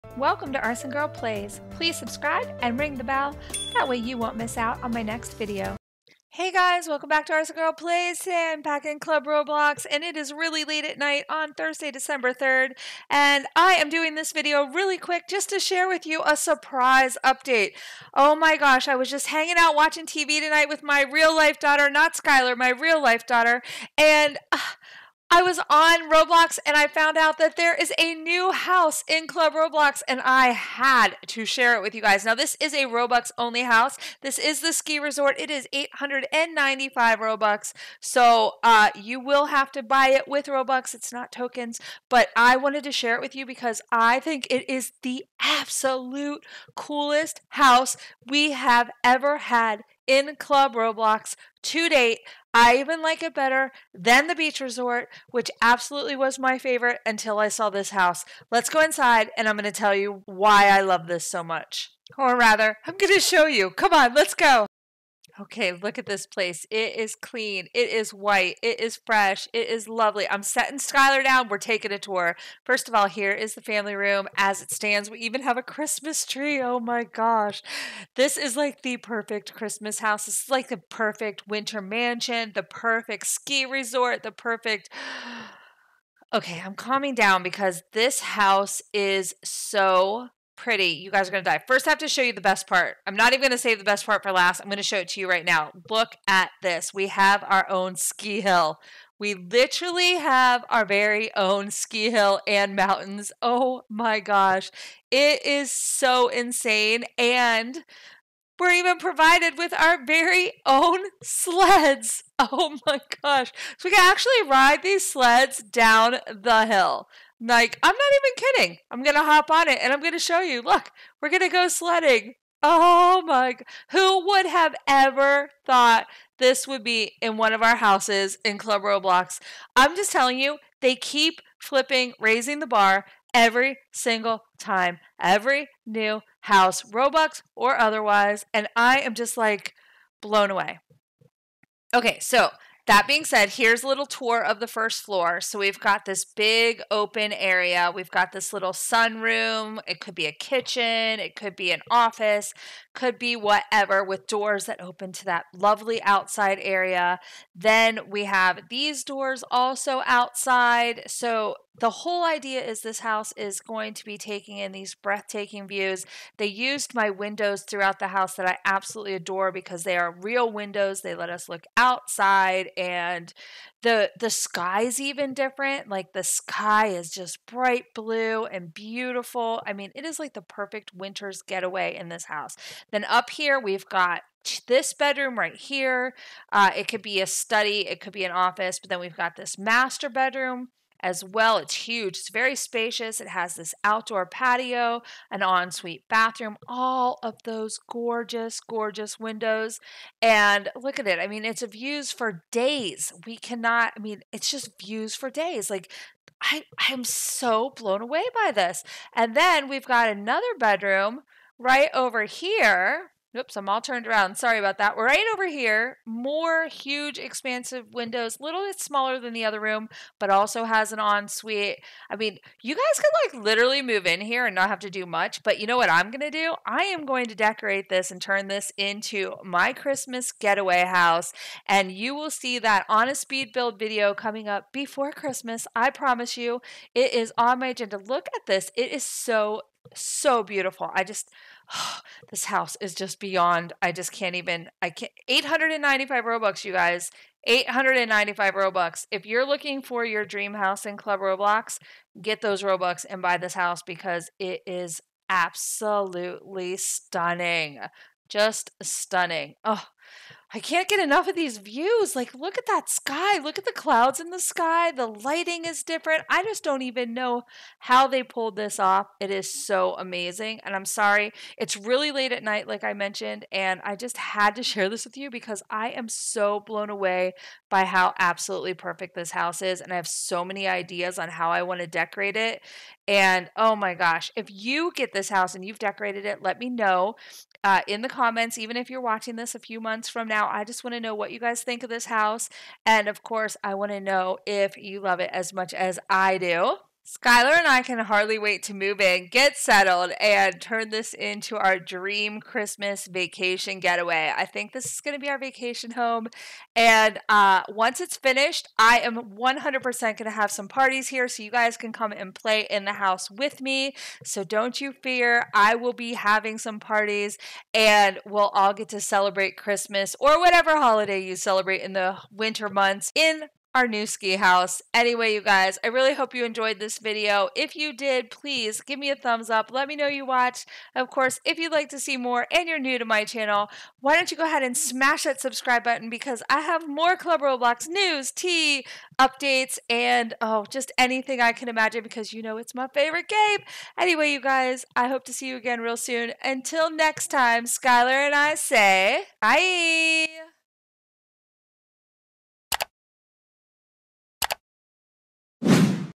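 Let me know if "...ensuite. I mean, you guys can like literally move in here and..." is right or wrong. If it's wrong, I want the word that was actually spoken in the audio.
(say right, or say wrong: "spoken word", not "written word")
right.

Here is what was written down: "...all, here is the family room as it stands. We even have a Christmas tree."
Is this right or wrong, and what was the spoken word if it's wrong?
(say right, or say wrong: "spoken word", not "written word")
right.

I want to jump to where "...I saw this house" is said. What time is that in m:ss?
0:57.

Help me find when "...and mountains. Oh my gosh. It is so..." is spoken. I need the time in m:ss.
1:42.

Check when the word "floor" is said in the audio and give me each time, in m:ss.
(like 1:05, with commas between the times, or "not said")
2:25.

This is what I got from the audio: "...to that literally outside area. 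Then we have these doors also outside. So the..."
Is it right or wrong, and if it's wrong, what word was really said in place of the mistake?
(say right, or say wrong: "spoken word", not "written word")
wrong: "lovely", not "literally".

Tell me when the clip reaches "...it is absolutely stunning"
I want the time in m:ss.
4:14.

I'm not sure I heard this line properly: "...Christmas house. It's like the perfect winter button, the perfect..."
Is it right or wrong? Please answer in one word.
wrong.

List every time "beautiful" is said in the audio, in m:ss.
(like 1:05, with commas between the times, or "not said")
2:58, 4:00.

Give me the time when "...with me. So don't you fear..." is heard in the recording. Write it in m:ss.
5:13.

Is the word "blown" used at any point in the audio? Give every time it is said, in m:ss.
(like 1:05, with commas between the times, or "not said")
2:20, 3:27, 4:36.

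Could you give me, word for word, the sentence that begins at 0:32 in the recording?
Now, this is a Robux only house.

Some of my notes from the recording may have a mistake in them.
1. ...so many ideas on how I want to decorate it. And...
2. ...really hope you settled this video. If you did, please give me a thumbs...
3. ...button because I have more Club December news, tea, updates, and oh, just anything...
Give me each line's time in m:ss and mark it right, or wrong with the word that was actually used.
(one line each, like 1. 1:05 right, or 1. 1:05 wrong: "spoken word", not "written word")
1. 4:40 right
2. 5:25 wrong: "enjoyed", not "settled"
3. 5:35 wrong: "Roblox", not "December".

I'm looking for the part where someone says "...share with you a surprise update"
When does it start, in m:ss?
0:15.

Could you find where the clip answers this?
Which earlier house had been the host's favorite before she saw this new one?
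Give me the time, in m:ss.
0:54.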